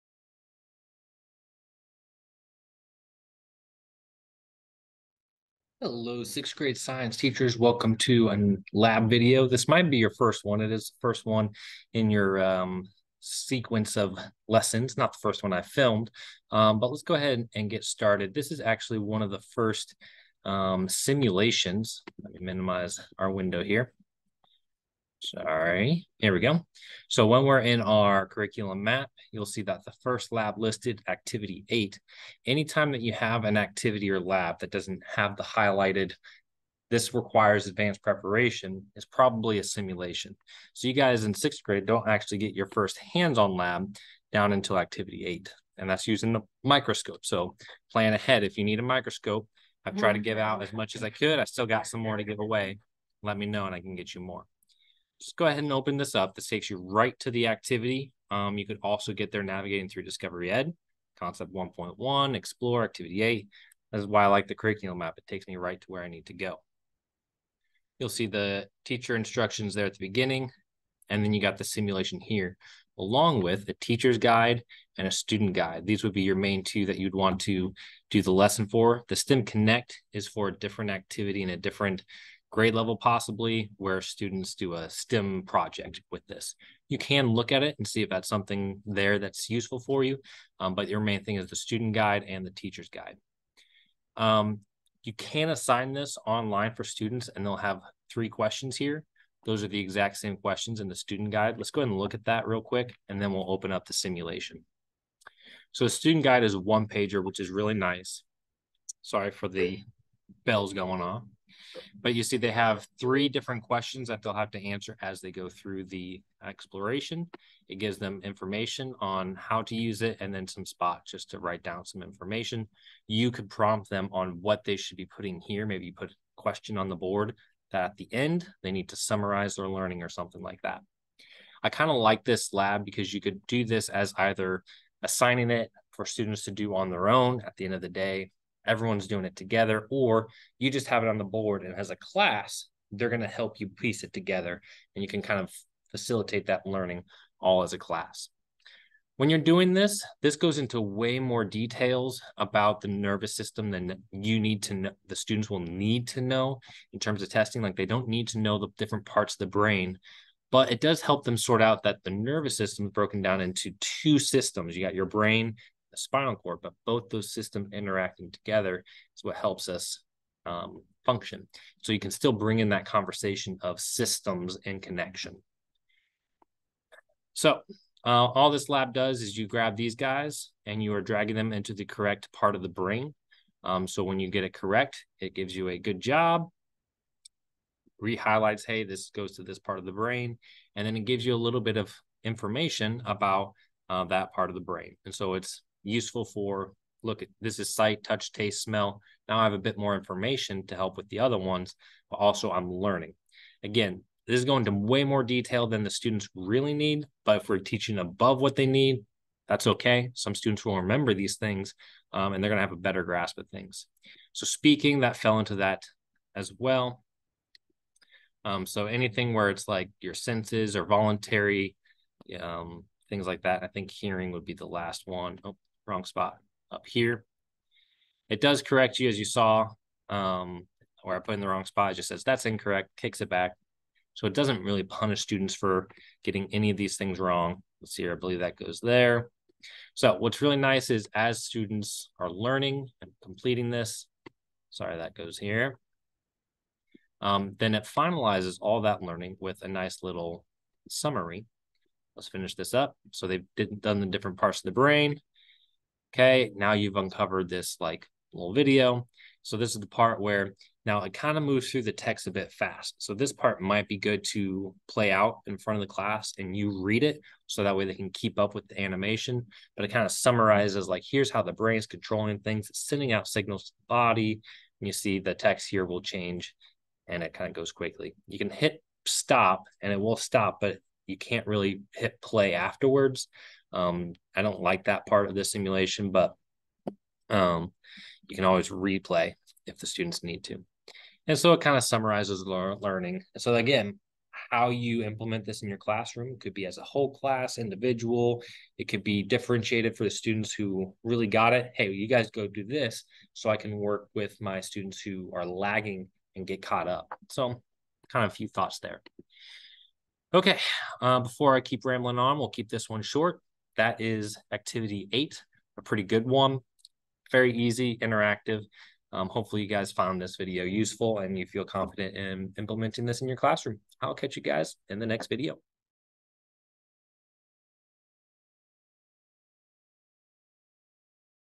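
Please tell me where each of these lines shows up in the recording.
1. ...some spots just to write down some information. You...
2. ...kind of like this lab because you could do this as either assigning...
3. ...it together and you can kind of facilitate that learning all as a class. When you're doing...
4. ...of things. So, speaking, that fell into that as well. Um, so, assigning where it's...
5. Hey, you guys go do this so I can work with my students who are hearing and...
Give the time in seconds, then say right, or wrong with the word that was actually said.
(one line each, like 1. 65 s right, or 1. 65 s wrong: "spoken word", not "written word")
1. 120 s right
2. 131 s right
3. 144 s right
4. 213 s wrong: "anything", not "assigning"
5. 301 s wrong: "lagging", not "hearing".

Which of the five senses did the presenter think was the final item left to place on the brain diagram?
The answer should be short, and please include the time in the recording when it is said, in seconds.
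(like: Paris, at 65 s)
hearing, at 223 s.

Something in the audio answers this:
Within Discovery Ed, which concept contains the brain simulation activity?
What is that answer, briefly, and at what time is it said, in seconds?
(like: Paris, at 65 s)
Concept 1.1, at 61 s.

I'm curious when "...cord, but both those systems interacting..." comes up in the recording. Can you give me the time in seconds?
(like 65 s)
166 s.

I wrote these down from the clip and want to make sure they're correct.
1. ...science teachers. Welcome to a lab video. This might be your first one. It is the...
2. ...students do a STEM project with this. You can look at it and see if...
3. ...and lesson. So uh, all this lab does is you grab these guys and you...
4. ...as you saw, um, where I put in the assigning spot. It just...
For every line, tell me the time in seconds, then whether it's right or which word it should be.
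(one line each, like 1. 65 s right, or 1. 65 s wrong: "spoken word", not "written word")
1. 6 s right
2. 84 s right
3. 174 s wrong: "connection", not "lesson"
4. 229 s wrong: "wrong", not "assigning".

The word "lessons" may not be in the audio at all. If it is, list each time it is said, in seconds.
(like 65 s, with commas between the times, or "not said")
14 s, 78 s.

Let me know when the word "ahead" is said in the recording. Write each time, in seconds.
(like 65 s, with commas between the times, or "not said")
17 s, 48 s, 55 s, 101 s.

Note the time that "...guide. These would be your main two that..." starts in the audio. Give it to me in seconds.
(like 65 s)
75 s.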